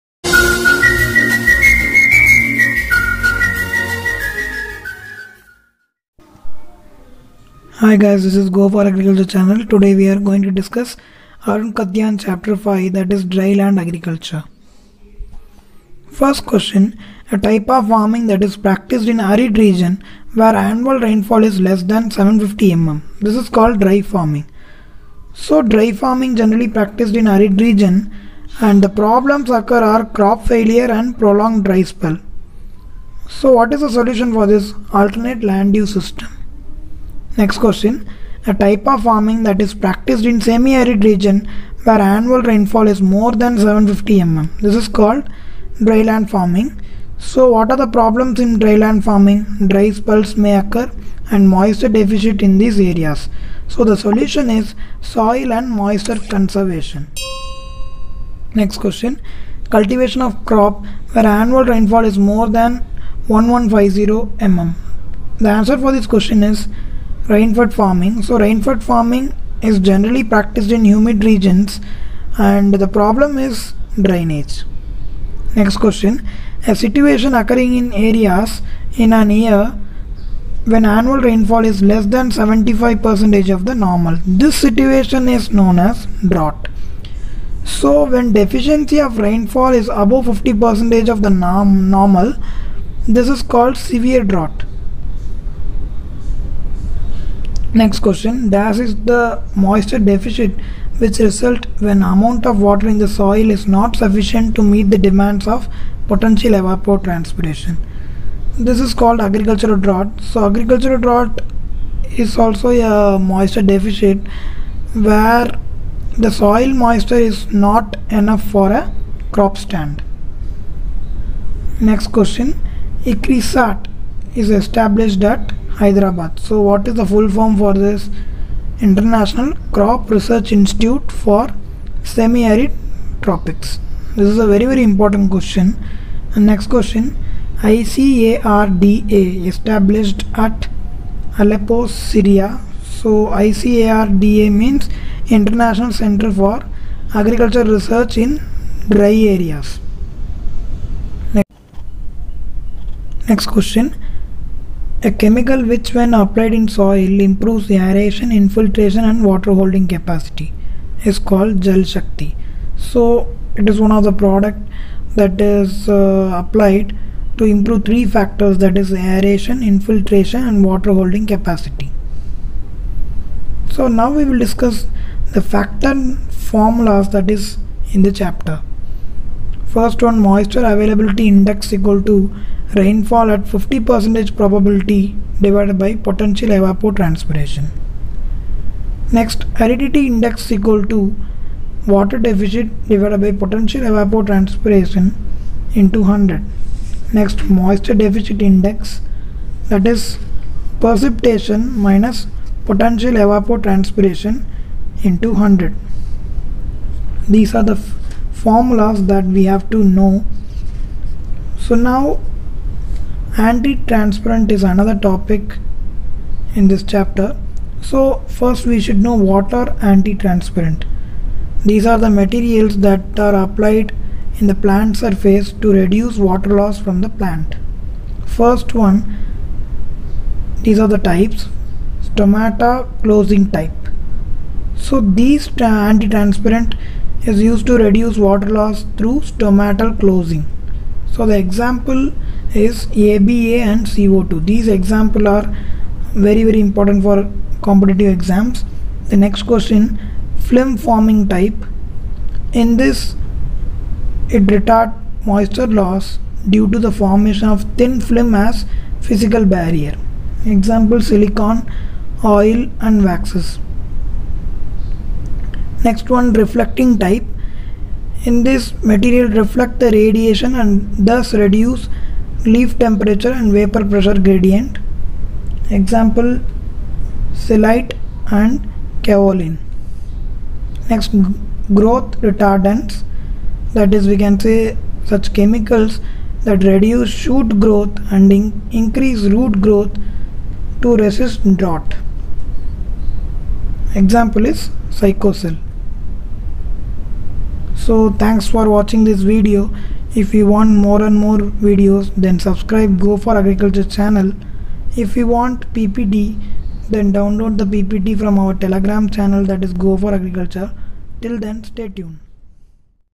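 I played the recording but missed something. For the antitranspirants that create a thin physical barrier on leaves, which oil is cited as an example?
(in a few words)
Silicon oil.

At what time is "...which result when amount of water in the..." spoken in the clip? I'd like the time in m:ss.
1:40.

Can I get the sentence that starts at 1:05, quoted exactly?
The answer for this question is rainfed farming.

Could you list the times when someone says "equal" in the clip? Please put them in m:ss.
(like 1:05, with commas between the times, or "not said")
3:01, 3:10.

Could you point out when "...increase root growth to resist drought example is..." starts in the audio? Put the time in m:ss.
4:48.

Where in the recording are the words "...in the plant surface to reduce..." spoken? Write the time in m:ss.
3:44.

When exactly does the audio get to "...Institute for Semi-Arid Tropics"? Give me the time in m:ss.
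2:10.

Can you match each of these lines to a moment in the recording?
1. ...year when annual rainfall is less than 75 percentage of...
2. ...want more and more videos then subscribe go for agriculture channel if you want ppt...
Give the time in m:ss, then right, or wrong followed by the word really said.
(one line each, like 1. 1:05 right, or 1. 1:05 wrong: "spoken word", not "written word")
1. 1:19 right
2. 5:00 right.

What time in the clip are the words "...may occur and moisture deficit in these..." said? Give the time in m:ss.
0:50.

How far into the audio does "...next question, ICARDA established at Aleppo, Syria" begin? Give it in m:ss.
2:16.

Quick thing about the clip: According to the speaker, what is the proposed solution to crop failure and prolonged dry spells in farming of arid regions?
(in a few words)
Alternate land use system.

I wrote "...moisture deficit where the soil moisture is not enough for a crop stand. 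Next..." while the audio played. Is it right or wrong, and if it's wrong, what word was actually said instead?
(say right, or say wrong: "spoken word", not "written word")
right.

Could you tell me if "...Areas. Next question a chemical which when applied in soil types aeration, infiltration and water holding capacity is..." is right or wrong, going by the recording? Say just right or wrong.
wrong.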